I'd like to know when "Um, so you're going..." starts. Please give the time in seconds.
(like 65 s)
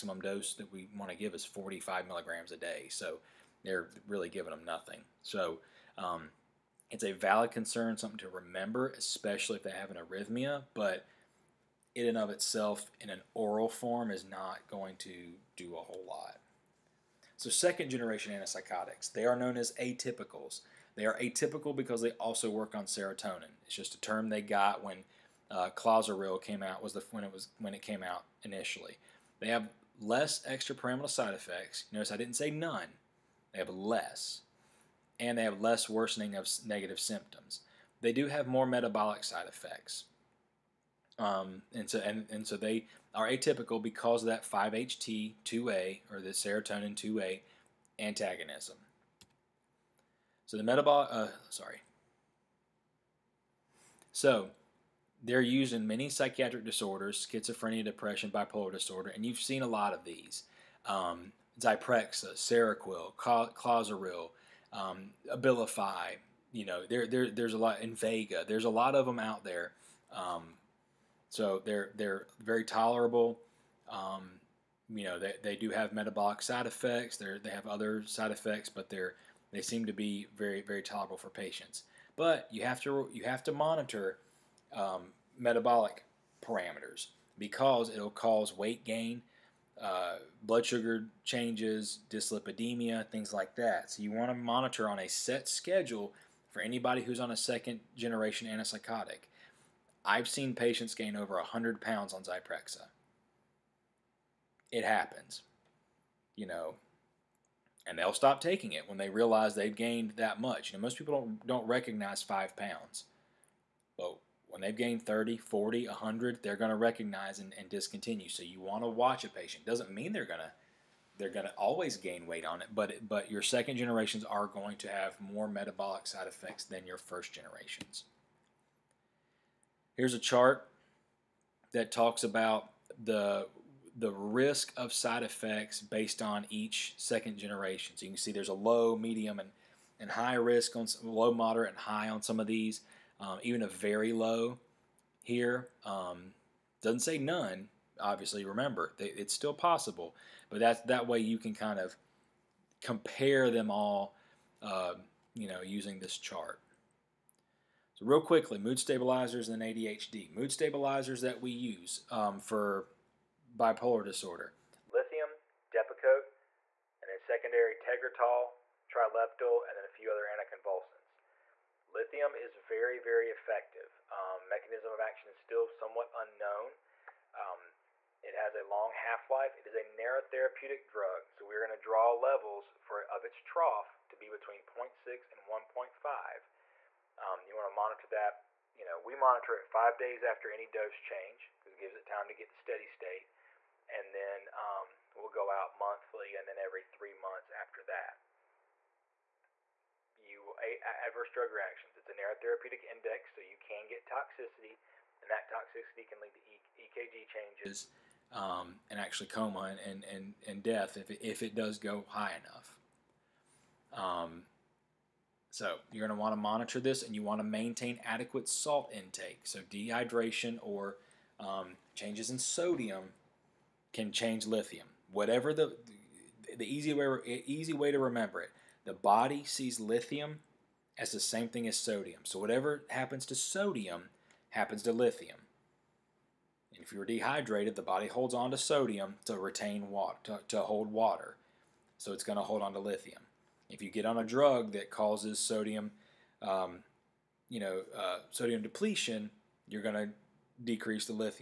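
214 s.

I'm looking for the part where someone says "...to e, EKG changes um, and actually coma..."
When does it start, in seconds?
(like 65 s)
206 s.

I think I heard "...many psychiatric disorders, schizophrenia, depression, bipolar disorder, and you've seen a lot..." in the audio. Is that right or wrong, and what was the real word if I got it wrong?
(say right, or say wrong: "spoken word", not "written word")
right.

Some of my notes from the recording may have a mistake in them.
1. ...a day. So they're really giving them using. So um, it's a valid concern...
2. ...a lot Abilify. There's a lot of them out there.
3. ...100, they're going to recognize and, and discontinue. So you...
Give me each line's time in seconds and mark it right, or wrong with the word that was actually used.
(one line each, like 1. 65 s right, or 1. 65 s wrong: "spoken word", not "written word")
1. 2 s wrong: "nothing", not "using"
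2. 67 s wrong: "Invega", not "Abilify"
3. 115 s right.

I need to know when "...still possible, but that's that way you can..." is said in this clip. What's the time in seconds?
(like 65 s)
149 s.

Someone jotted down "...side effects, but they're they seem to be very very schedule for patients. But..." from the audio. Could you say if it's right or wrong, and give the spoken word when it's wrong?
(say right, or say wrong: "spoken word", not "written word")
wrong: "tolerable", not "schedule".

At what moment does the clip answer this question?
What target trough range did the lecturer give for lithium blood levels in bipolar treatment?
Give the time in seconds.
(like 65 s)
184 s.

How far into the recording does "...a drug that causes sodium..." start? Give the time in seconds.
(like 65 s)
244 s.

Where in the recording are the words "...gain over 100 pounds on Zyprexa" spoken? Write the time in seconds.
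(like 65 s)
100 s.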